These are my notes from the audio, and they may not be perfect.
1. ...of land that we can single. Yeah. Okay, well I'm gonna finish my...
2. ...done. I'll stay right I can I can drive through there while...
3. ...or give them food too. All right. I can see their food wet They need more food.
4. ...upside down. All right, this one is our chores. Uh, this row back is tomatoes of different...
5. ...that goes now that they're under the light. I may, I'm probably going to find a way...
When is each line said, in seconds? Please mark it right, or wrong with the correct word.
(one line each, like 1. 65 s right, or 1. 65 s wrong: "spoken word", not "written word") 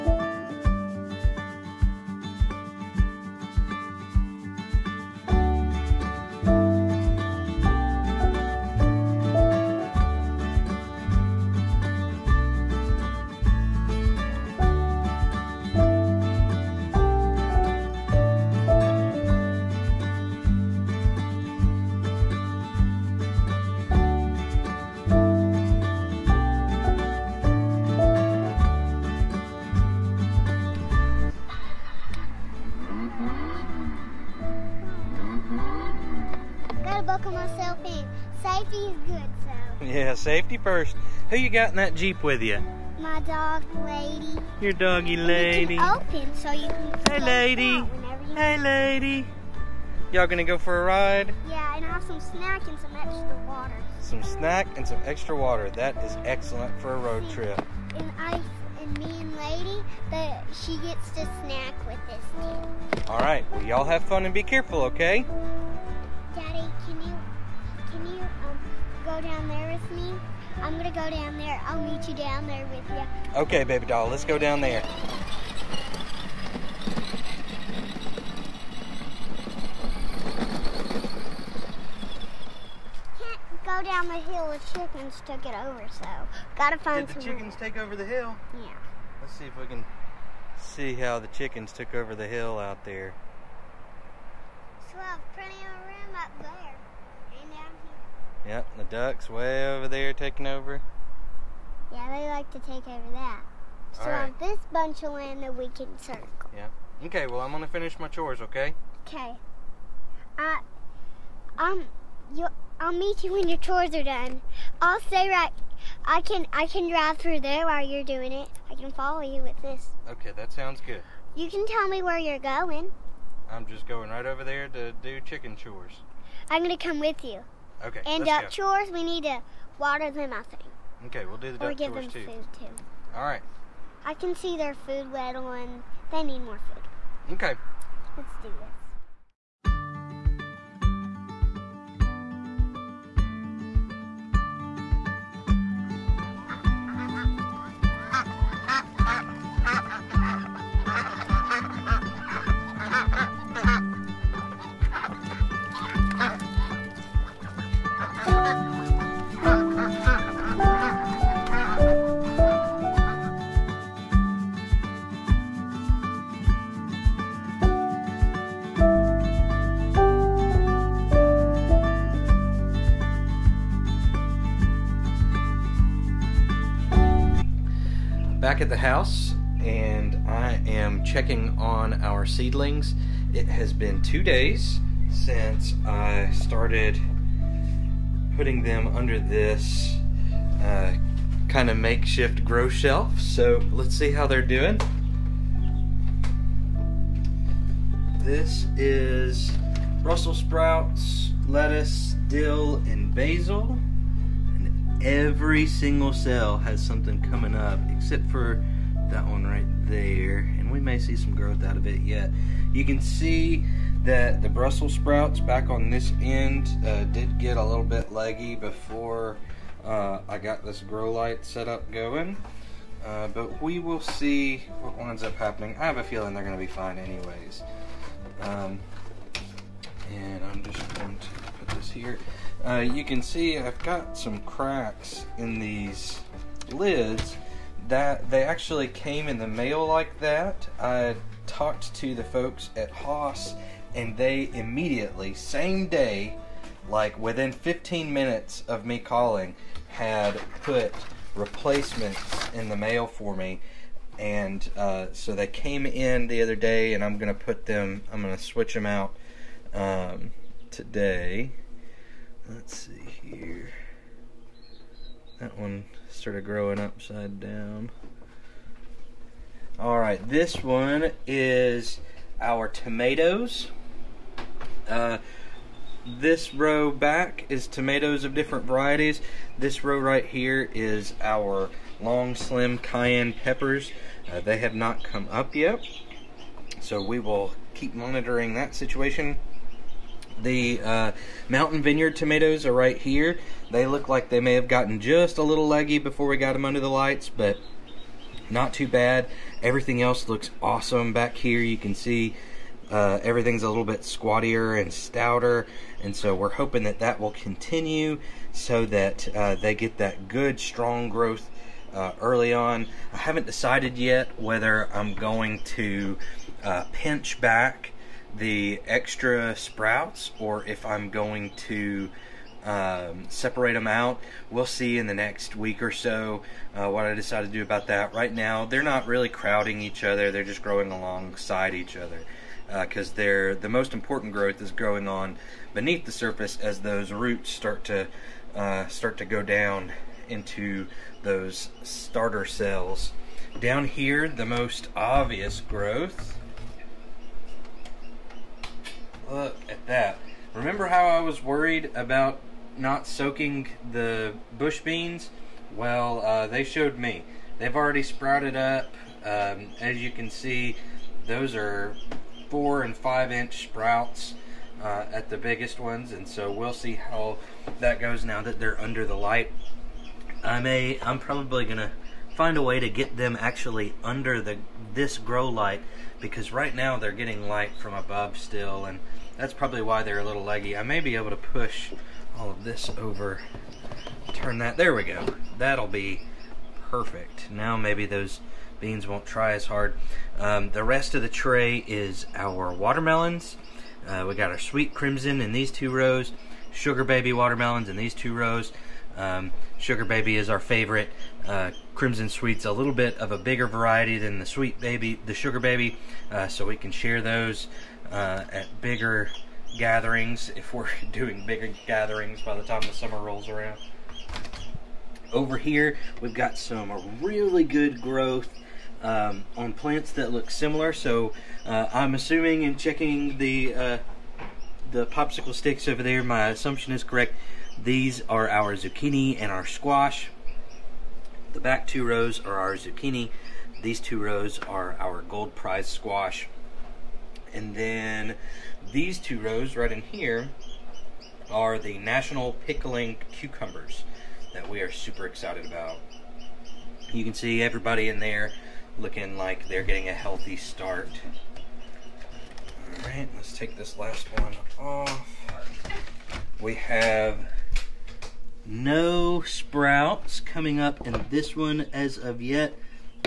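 1. 105 s wrong: "circle", not "single"
2. 114 s right
3. 131 s right
4. 266 s wrong: "tomatoes", not "chores"
5. 367 s right.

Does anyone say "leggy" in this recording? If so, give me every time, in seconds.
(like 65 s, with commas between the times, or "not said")
218 s, 295 s, 380 s.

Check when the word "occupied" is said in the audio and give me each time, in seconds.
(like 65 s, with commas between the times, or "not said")
not said.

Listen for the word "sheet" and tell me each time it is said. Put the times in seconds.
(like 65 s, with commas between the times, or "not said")
not said.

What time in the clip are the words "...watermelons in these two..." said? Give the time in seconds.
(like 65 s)
397 s.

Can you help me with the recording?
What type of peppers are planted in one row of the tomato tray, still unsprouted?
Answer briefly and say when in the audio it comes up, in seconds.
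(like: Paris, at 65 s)
long slim cayenne, at 281 s.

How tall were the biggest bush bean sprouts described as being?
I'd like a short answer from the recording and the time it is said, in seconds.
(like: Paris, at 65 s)
4 to 5 inches, at 362 s.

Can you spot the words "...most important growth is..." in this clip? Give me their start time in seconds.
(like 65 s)
333 s.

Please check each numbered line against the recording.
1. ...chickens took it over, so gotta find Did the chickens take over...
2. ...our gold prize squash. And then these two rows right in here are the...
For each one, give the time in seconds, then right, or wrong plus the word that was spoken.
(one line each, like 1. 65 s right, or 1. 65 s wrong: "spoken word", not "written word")
1. 84 s right
2. 434 s right.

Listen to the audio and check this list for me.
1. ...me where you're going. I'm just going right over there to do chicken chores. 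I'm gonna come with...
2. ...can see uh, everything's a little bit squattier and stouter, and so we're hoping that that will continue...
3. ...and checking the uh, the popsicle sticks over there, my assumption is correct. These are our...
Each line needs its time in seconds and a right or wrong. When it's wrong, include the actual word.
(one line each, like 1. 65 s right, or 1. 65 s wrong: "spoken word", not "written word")
1. 121 s right
2. 301 s right
3. 422 s right.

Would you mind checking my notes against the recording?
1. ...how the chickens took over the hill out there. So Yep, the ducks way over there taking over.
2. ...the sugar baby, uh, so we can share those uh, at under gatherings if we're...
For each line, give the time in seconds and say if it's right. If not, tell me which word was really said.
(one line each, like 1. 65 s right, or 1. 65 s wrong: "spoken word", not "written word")
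1. 90 s right
2. 405 s wrong: "bigger", not "under".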